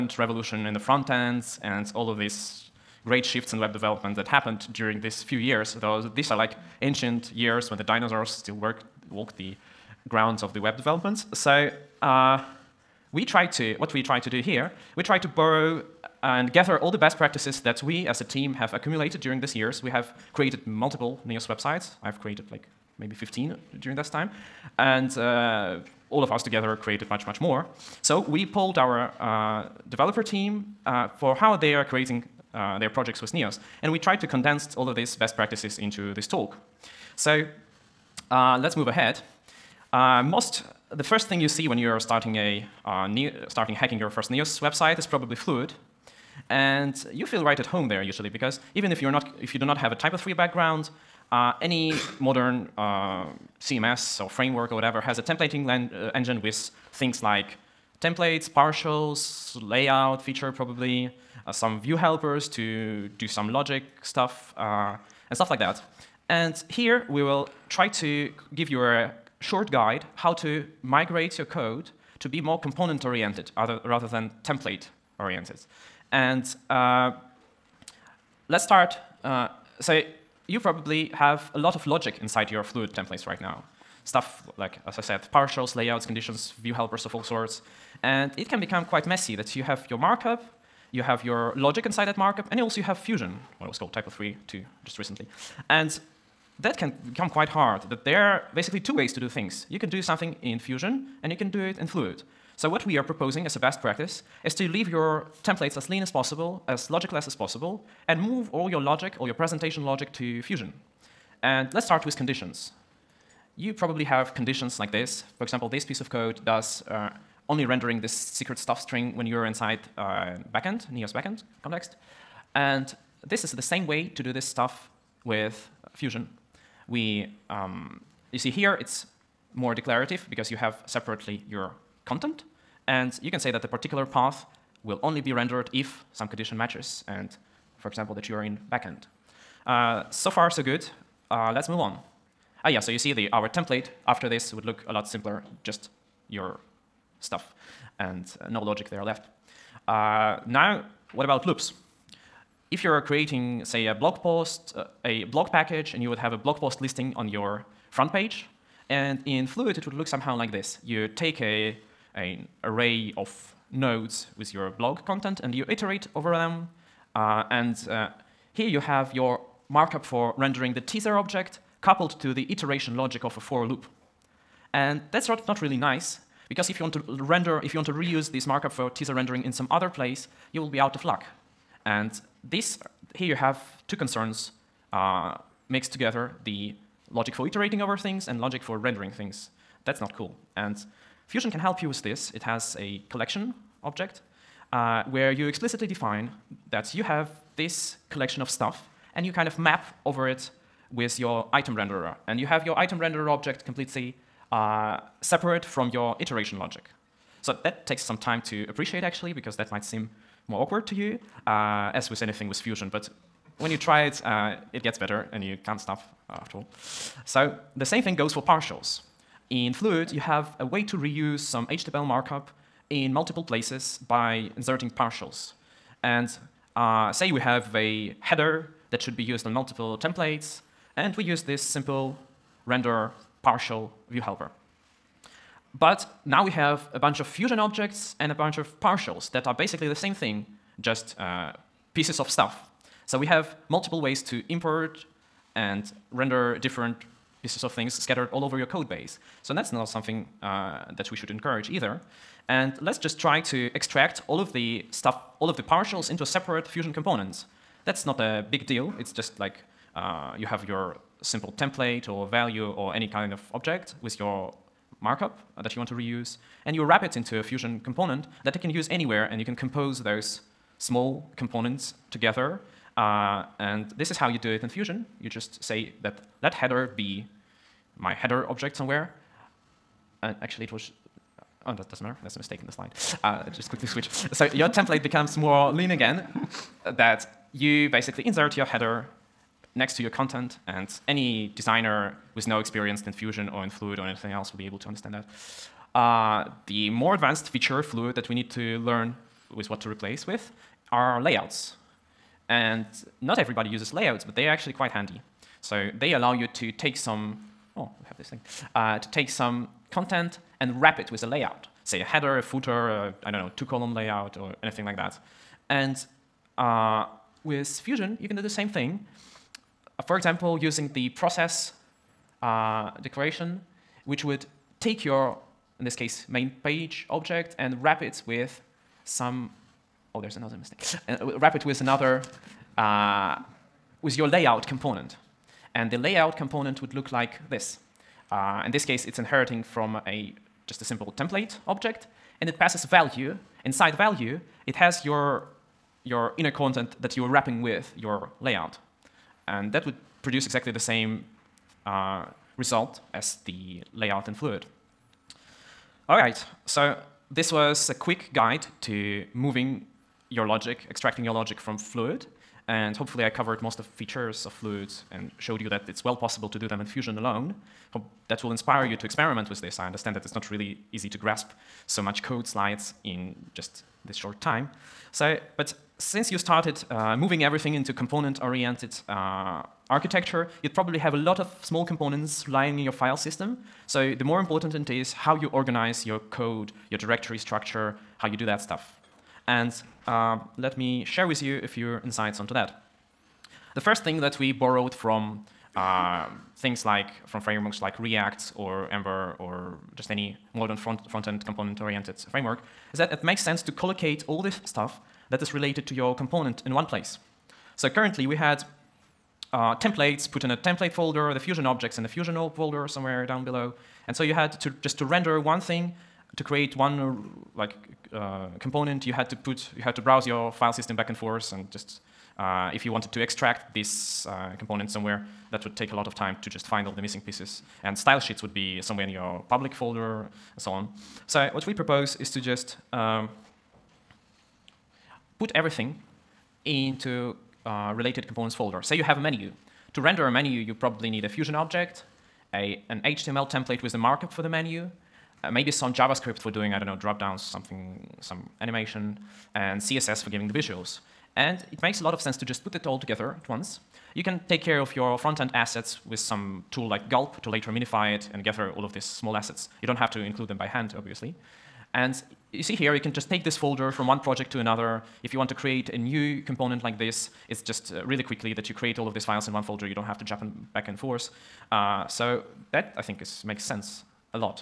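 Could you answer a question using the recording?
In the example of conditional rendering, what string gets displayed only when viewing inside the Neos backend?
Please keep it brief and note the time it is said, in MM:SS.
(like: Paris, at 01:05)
secret stuff, at 01:58.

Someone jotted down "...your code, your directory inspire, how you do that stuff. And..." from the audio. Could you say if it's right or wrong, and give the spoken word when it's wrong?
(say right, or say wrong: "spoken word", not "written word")
wrong: "structure", not "inspire".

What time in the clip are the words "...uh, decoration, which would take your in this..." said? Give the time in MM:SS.
05:22.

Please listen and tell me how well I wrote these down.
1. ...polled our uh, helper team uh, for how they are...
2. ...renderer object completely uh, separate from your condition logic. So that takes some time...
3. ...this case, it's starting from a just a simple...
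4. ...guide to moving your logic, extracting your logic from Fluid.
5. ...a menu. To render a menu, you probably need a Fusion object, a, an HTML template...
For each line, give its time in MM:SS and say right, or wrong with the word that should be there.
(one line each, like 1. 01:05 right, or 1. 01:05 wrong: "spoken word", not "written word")
1. 00:28 wrong: "developer", not "helper"
2. 03:22 wrong: "iteration", not "condition"
3. 05:38 wrong: "inheriting", not "starting"
4. 05:58 right
5. 07:19 right.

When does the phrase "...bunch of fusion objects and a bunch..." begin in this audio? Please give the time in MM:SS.
03:56.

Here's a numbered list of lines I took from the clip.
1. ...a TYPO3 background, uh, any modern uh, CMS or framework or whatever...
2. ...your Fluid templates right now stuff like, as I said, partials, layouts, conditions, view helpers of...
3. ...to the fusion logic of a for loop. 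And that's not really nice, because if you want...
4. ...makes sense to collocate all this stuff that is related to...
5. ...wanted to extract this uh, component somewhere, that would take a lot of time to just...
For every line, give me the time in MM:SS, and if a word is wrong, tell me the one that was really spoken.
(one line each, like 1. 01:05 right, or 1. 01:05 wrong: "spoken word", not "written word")
1. 00:49 right
2. 01:22 right
3. 02:52 wrong: "iteration", not "fusion"
4. 06:43 right
5. 07:02 right.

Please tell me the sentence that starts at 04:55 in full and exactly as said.
Uh, the more advanced feature Fluid that we need to learn with what to replace with are layouts.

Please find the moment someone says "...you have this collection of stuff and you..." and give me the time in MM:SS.
03:16.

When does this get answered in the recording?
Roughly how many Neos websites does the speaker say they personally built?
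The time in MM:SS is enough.
00:23.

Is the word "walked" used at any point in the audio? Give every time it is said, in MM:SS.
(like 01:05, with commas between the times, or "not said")
00:09.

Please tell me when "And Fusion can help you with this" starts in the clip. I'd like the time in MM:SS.
03:10.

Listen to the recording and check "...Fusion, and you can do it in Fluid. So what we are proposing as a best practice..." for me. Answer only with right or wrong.
right.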